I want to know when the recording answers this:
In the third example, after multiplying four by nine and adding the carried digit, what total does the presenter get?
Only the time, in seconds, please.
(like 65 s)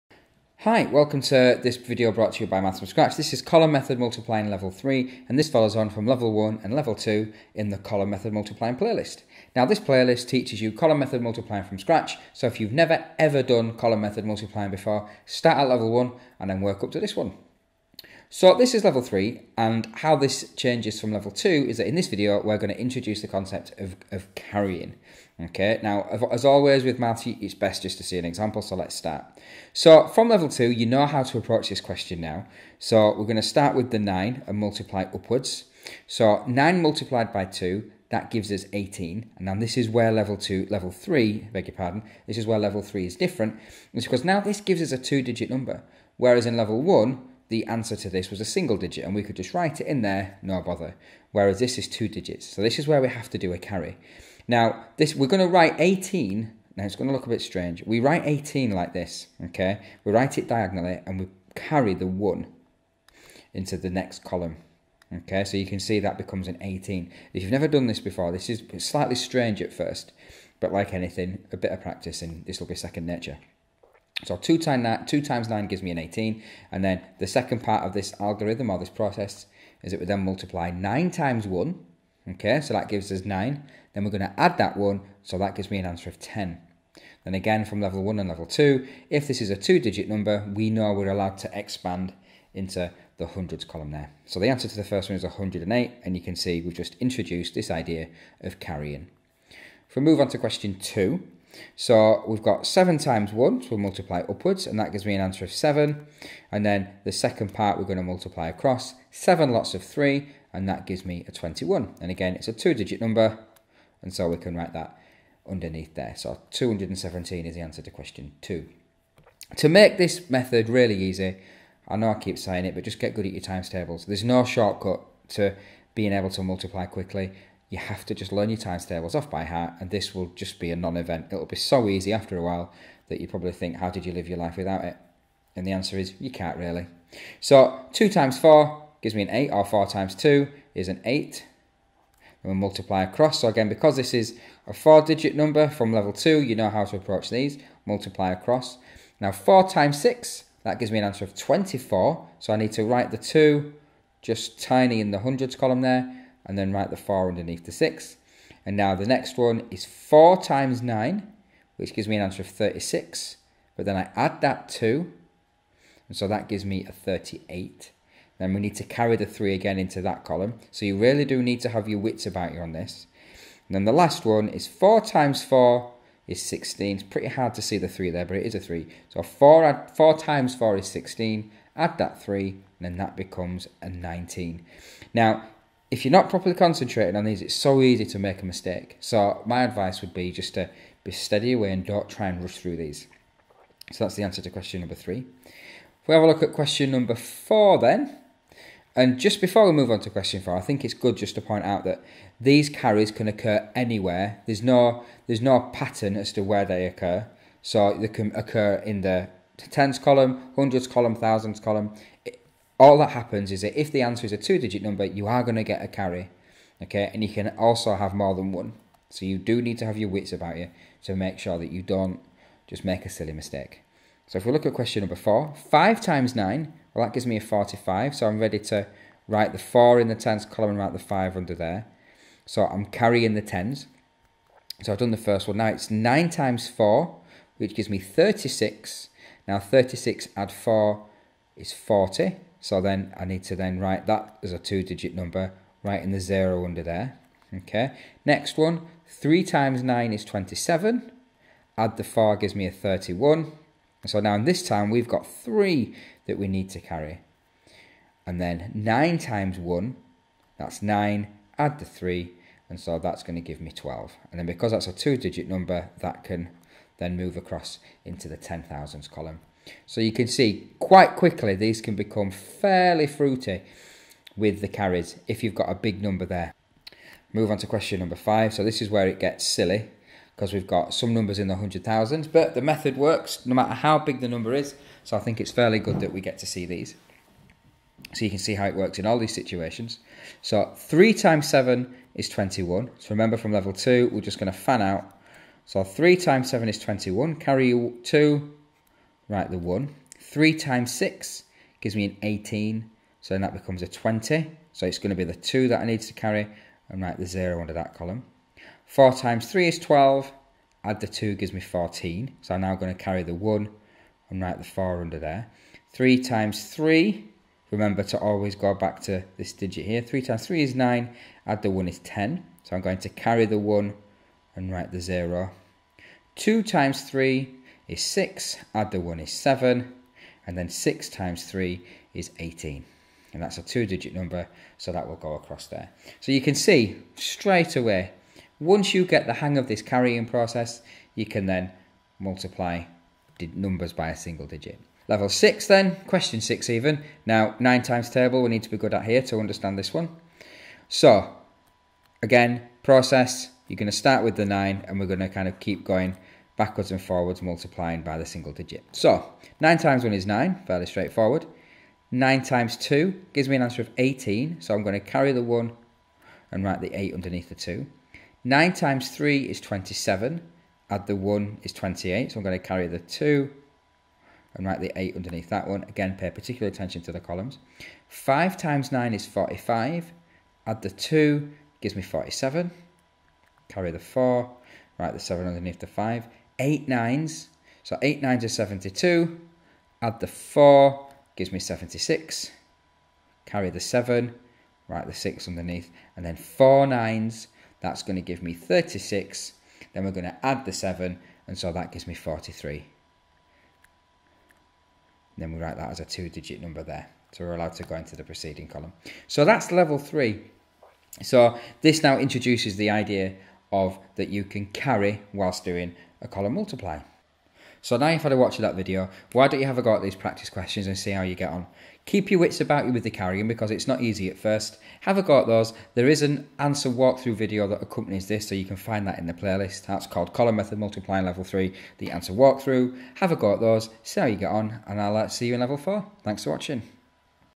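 166 s.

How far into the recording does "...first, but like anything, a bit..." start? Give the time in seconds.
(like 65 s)
69 s.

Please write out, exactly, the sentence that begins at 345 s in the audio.
Level 6 then, question 6 even.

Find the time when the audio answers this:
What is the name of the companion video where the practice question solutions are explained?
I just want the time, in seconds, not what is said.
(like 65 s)
431 s.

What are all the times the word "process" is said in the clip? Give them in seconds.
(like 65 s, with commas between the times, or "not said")
78 s, 340 s, 352 s.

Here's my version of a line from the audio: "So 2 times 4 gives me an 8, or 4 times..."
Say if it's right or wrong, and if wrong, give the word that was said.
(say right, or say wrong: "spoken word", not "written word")
right.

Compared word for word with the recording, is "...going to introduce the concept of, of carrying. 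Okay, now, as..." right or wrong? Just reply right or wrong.
right.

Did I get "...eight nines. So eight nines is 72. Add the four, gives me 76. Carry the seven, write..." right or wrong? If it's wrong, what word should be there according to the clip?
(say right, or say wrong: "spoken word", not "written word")
right.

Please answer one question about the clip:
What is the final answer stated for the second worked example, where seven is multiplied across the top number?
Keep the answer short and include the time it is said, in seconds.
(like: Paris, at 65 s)
217, at 116 s.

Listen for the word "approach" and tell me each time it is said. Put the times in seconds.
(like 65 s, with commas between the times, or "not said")
31 s, 146 s.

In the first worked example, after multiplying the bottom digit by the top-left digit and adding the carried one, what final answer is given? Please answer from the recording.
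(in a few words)
108.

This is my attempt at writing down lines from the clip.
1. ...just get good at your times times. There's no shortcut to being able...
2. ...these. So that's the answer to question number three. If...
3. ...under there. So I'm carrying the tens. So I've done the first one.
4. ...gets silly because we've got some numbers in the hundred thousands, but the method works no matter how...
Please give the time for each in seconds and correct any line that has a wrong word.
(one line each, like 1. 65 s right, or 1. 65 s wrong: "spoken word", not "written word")
1. 122 s wrong: "tables", not "times"
2. 192 s right
3. 231 s right
4. 279 s right.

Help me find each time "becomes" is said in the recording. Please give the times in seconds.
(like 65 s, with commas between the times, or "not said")
66 s, 183 s, 271 s, 303 s.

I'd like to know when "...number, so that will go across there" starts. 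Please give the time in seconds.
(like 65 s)
334 s.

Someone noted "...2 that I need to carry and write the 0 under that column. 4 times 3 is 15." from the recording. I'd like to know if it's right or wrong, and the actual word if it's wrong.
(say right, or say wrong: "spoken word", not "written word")
wrong: "12", not "15".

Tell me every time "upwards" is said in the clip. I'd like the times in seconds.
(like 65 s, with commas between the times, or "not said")
35 s, 104 s.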